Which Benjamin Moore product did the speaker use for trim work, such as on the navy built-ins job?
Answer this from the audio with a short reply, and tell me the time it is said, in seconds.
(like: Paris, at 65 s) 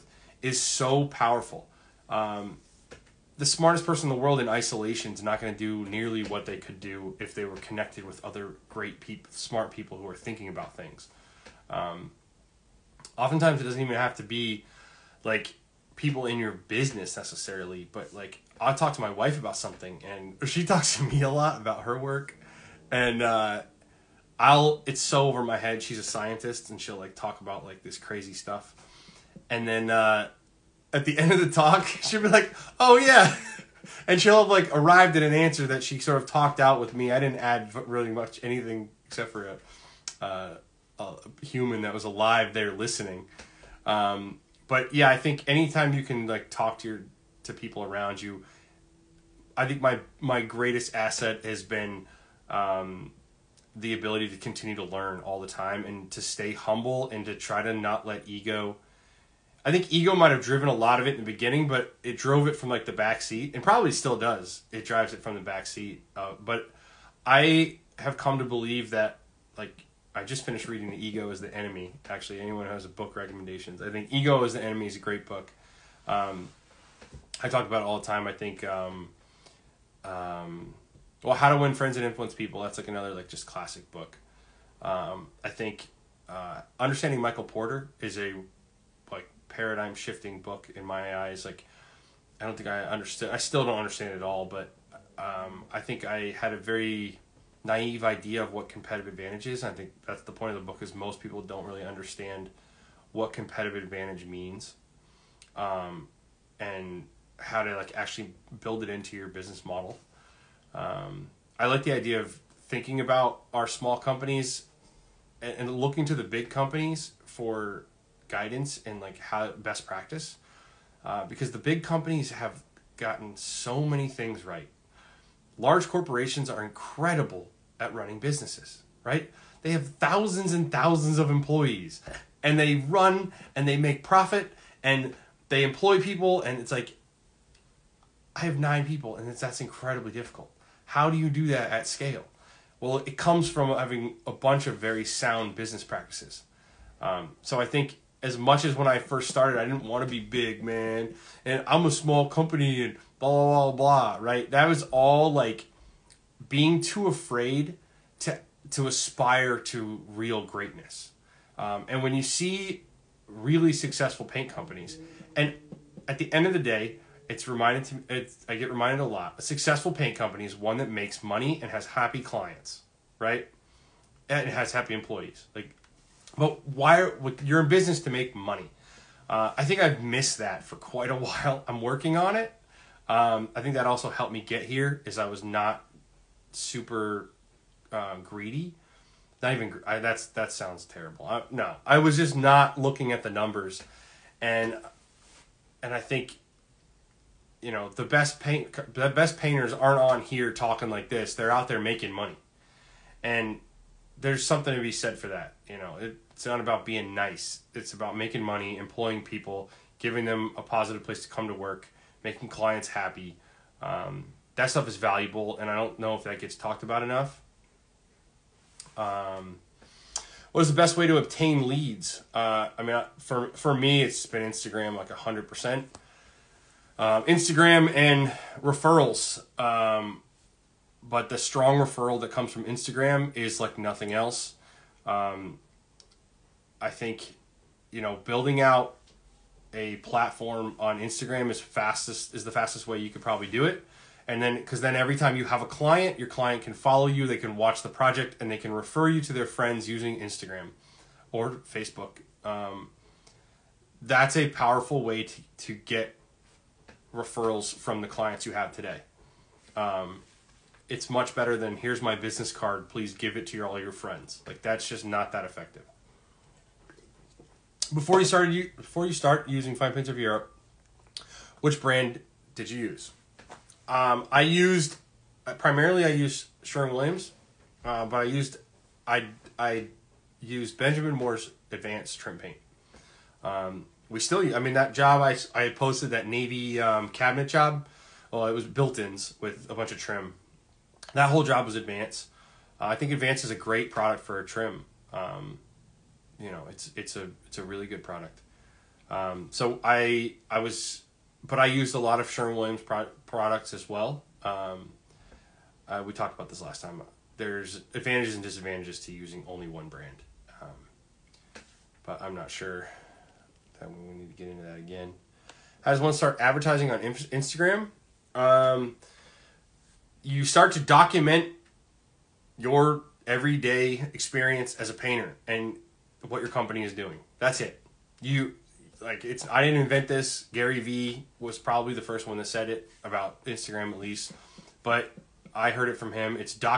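Advanced Trim Paint, at 281 s.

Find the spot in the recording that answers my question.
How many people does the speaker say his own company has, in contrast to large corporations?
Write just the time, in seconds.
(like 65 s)
138 s.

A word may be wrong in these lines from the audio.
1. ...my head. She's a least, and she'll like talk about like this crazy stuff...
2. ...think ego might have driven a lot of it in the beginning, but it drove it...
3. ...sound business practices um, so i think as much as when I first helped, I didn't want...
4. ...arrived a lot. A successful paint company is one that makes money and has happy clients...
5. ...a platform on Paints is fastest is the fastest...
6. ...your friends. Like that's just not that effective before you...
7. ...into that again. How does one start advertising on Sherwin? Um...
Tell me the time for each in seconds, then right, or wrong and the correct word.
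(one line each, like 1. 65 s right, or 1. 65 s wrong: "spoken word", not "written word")
1. 25 s wrong: "scientist", not "least"
2. 59 s right
3. 145 s wrong: "started", not "helped"
4. 168 s wrong: "reminded", not "arrived"
5. 239 s wrong: "Instagram", not "Paints"
6. 263 s right
7. 314 s wrong: "Instagram", not "Sherwin".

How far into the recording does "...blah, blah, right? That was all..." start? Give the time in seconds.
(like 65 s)
153 s.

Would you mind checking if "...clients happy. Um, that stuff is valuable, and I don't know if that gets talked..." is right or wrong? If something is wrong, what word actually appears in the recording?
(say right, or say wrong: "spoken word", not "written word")
right.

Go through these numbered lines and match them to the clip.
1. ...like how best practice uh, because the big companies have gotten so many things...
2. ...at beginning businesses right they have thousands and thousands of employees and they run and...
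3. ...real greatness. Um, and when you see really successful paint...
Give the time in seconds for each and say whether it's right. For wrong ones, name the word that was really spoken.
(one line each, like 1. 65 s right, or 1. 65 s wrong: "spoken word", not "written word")
1. 119 s right
2. 127 s wrong: "running", not "beginning"
3. 160 s right.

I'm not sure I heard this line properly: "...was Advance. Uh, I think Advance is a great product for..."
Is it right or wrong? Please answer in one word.
right.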